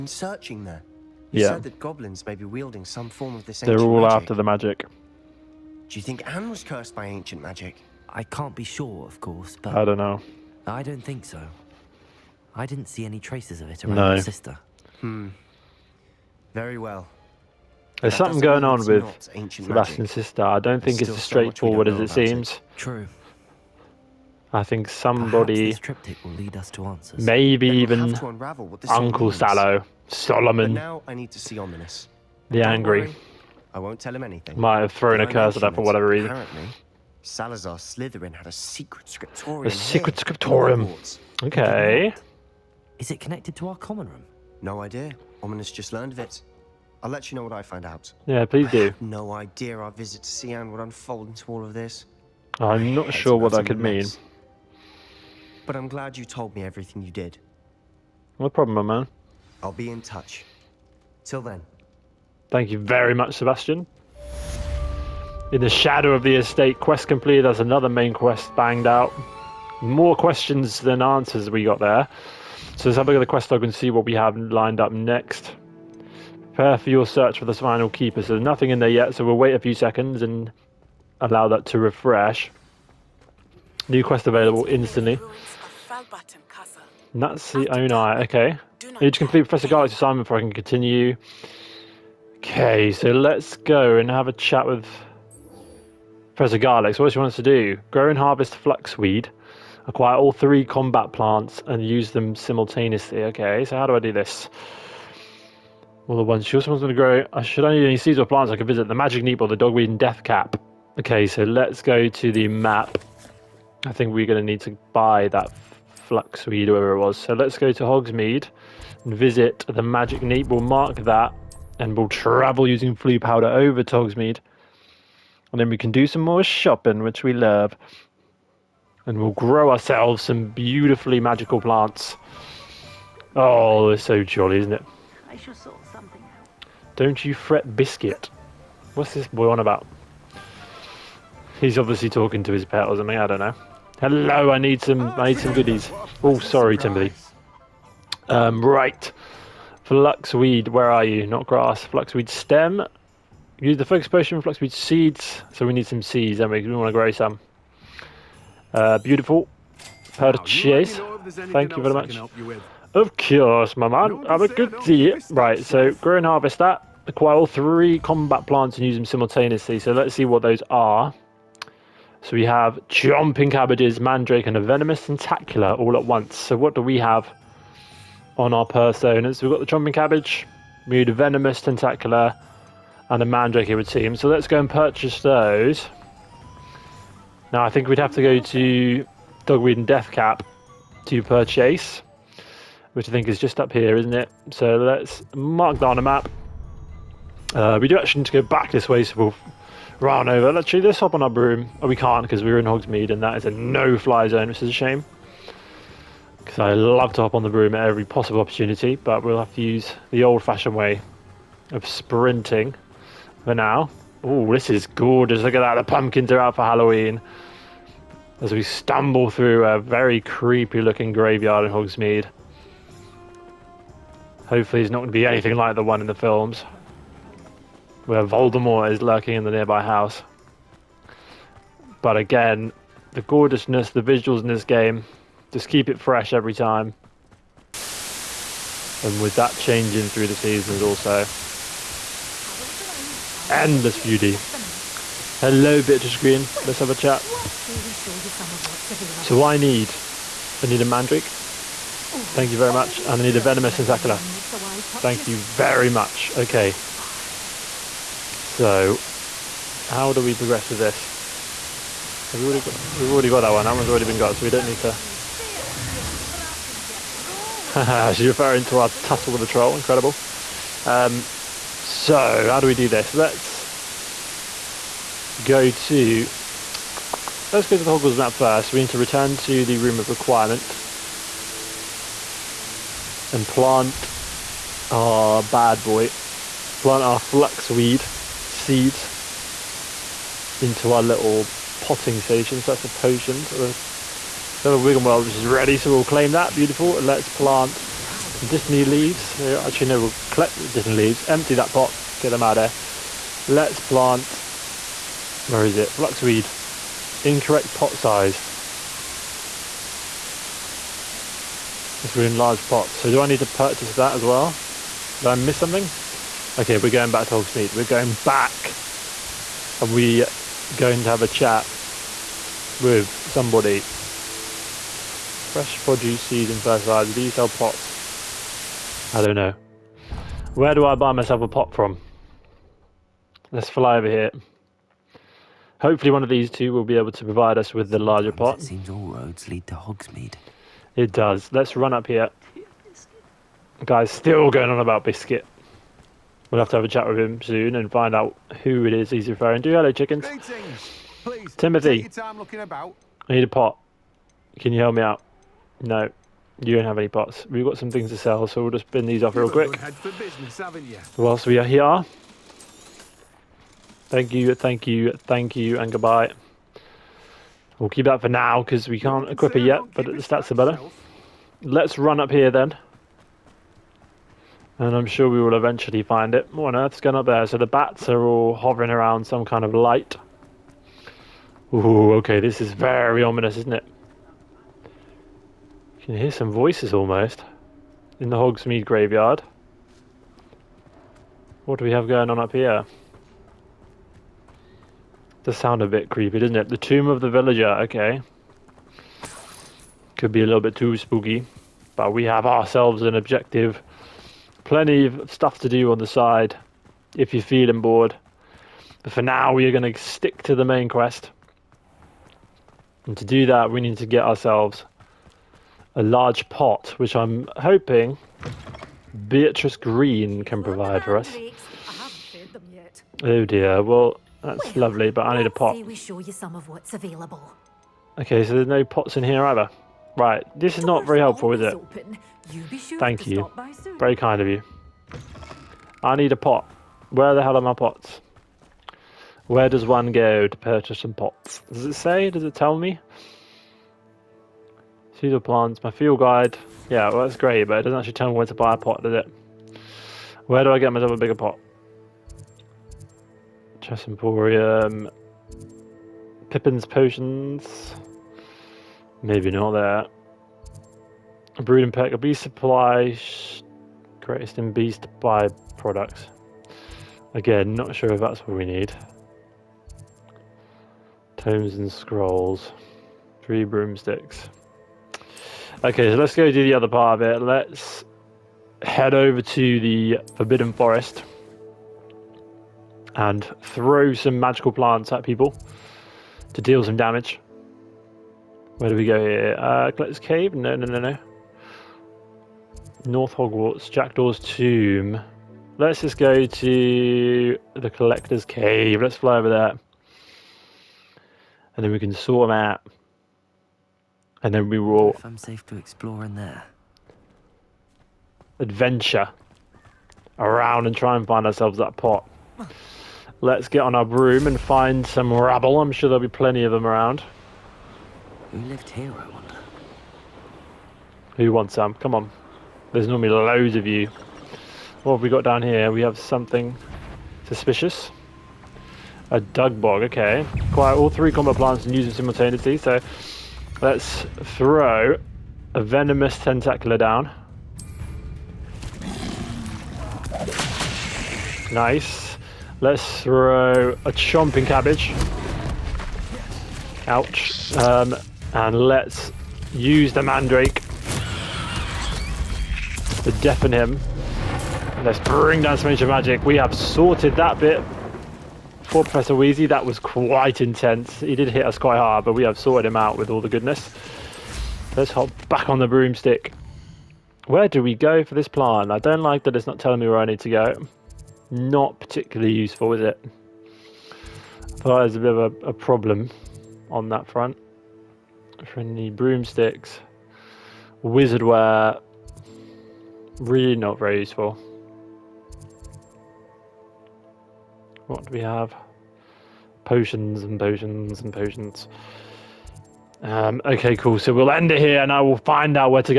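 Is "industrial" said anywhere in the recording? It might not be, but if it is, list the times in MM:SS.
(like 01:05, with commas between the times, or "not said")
not said.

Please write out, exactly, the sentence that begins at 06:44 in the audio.
Plenty of stuff to do on the side if you're feeling bored.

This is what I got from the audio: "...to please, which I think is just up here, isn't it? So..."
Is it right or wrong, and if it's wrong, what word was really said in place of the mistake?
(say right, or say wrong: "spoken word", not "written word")
wrong: "purchase", not "please".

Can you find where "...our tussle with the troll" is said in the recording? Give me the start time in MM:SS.
04:28.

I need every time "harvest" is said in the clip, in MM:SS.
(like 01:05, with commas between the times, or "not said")
01:38, 02:46.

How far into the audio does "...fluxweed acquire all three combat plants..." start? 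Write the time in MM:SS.
01:38.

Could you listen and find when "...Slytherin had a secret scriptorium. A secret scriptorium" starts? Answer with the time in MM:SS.
00:37.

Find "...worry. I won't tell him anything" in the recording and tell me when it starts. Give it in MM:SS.
00:33.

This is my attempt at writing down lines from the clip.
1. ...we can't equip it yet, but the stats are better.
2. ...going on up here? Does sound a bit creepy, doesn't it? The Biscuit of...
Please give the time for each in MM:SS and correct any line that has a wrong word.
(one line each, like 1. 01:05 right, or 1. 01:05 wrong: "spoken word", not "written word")
1. 06:08 right
2. 06:32 wrong: "Tomb", not "Biscuit".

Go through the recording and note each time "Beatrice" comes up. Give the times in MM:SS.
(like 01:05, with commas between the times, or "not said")
06:59.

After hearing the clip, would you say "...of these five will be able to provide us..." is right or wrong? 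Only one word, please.
wrong.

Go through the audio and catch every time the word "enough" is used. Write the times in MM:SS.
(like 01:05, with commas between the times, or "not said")
not said.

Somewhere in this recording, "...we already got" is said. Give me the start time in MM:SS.
04:22.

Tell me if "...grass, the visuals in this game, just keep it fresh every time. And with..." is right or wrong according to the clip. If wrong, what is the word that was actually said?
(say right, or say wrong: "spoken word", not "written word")
wrong: "gorgeousness", not "grass".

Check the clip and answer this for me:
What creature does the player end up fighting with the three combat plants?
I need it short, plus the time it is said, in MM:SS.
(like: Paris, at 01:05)
A Dugbog, at 08:49.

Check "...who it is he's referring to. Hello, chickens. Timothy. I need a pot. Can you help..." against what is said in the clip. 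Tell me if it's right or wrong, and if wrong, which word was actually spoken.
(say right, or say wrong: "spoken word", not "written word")
right.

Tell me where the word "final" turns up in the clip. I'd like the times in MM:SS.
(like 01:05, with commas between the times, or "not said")
01:17.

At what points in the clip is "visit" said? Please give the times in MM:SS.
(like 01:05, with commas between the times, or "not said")
00:49, 01:48, 01:59.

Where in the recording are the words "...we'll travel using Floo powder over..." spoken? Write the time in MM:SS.
02:01.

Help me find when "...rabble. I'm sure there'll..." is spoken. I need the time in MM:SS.
08:35.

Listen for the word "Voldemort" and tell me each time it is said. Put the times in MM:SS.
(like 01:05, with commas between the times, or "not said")
03:48.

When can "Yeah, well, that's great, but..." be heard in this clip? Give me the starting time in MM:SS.
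07:26.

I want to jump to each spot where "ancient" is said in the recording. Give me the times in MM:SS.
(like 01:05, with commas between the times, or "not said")
00:07, 09:15.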